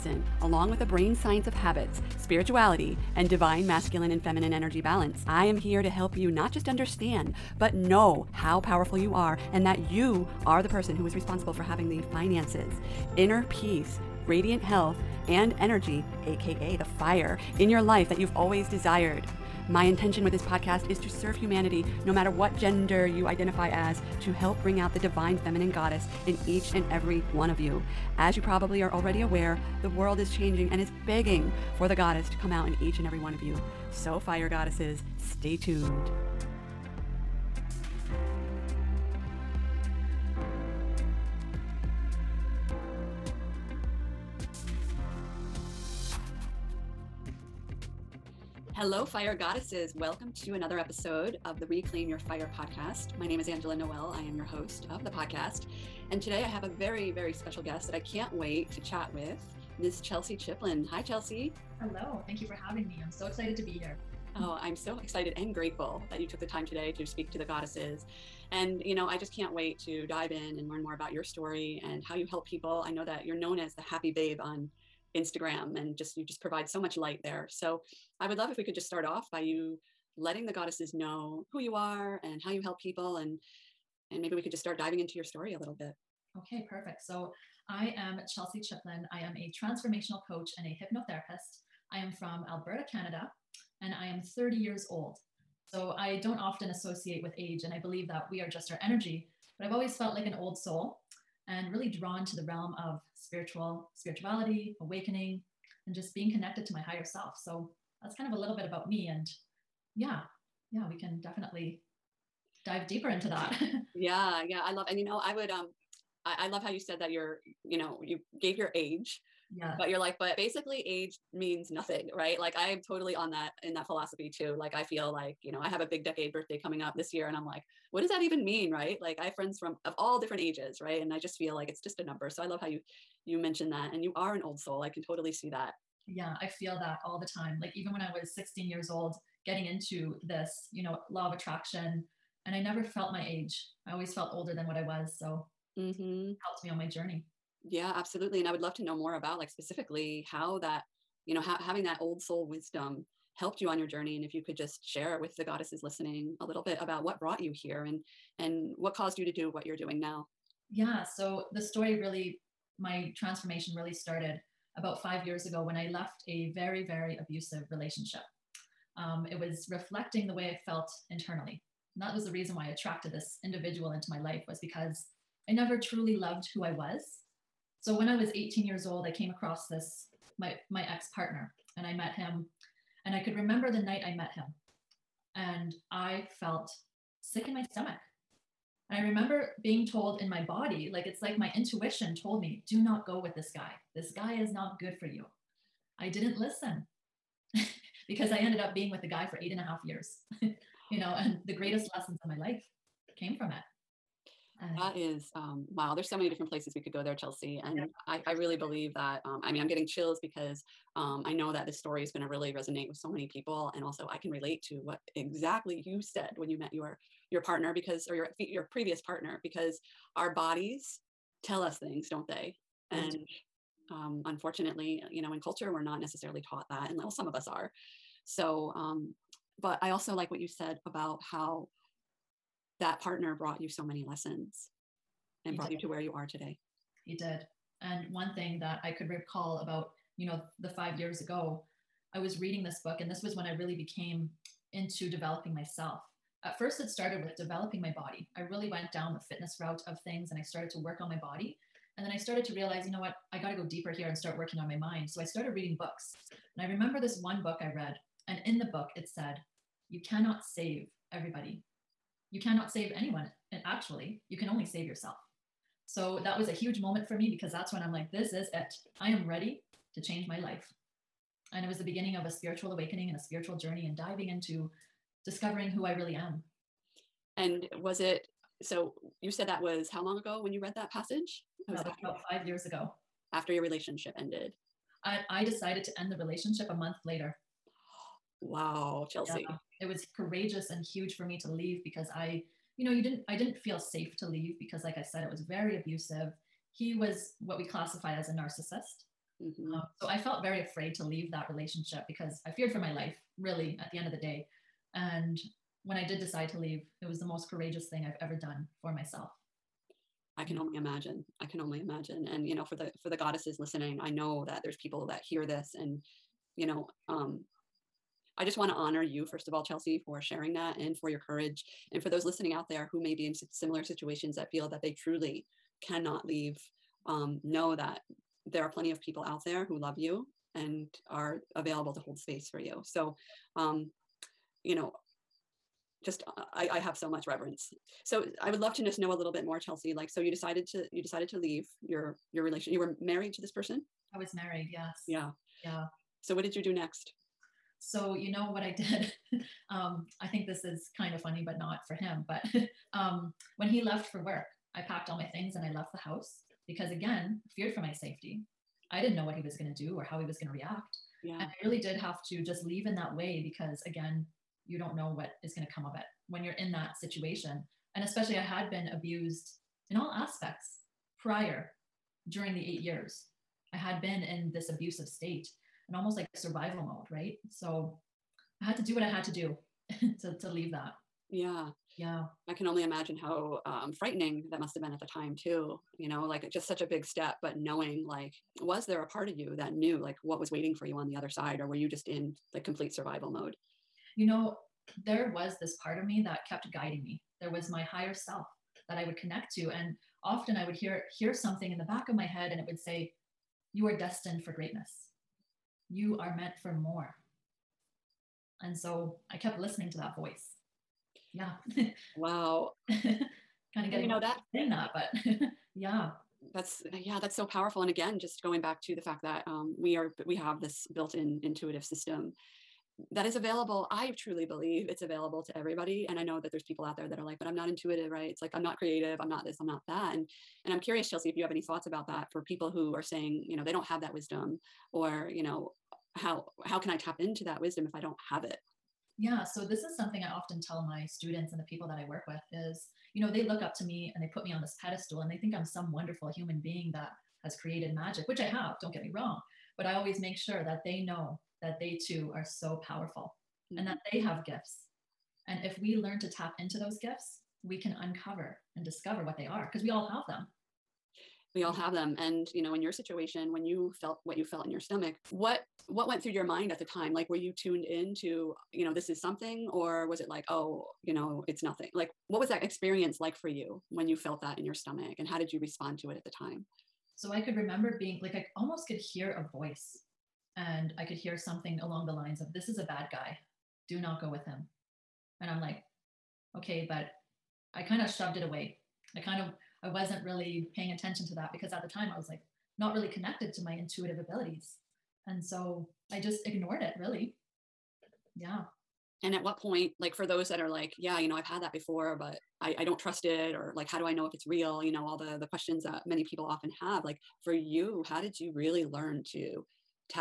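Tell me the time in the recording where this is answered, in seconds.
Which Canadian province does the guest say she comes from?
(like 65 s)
92 s.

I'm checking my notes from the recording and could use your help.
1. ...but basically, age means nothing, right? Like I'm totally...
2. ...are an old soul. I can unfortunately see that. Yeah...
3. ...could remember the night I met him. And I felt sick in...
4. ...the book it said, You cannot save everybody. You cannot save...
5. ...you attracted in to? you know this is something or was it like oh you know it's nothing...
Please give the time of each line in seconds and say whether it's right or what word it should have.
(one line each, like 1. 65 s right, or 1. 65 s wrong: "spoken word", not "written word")
1. 120 s right
2. 134 s wrong: "totally", not "unfortunately"
3. 183 s right
4. 258 s right
5. 467 s wrong: "tuned", not "attracted".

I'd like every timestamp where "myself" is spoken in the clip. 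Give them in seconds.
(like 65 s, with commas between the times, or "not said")
245 s, 308 s.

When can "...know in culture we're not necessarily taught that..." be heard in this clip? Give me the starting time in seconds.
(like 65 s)
225 s.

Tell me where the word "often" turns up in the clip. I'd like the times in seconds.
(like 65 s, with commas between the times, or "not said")
96 s, 400 s, 440 s, 506 s.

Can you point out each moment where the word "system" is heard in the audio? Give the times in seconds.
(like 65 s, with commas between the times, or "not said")
421 s.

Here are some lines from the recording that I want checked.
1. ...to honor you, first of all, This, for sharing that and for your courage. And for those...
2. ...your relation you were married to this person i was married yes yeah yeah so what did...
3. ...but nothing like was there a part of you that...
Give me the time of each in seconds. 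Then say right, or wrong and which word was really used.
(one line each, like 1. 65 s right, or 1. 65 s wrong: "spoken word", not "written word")
1. 318 s wrong: "Chelsie", not "This"
2. 342 s right
3. 387 s wrong: "knowing", not "nothing".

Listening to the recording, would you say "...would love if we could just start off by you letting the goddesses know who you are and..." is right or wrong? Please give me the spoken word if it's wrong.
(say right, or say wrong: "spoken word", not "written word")
right.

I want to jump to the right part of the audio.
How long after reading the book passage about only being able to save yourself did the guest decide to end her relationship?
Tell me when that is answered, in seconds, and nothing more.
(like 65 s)
286 s.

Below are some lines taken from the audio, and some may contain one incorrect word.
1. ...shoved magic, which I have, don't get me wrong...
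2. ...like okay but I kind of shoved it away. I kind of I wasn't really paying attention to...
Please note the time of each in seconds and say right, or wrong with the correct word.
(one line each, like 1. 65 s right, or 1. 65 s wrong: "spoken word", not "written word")
1. 447 s wrong: "created", not "shoved"
2. 485 s right.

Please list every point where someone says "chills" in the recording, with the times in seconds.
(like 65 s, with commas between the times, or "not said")
209 s.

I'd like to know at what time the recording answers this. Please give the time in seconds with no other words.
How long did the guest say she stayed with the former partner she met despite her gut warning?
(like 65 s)
199 s.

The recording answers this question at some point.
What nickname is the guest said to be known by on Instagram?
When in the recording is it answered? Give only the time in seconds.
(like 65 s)
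73 s.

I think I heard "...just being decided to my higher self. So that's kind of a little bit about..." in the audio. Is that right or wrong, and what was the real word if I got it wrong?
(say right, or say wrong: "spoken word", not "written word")
wrong: "connected", not "decided".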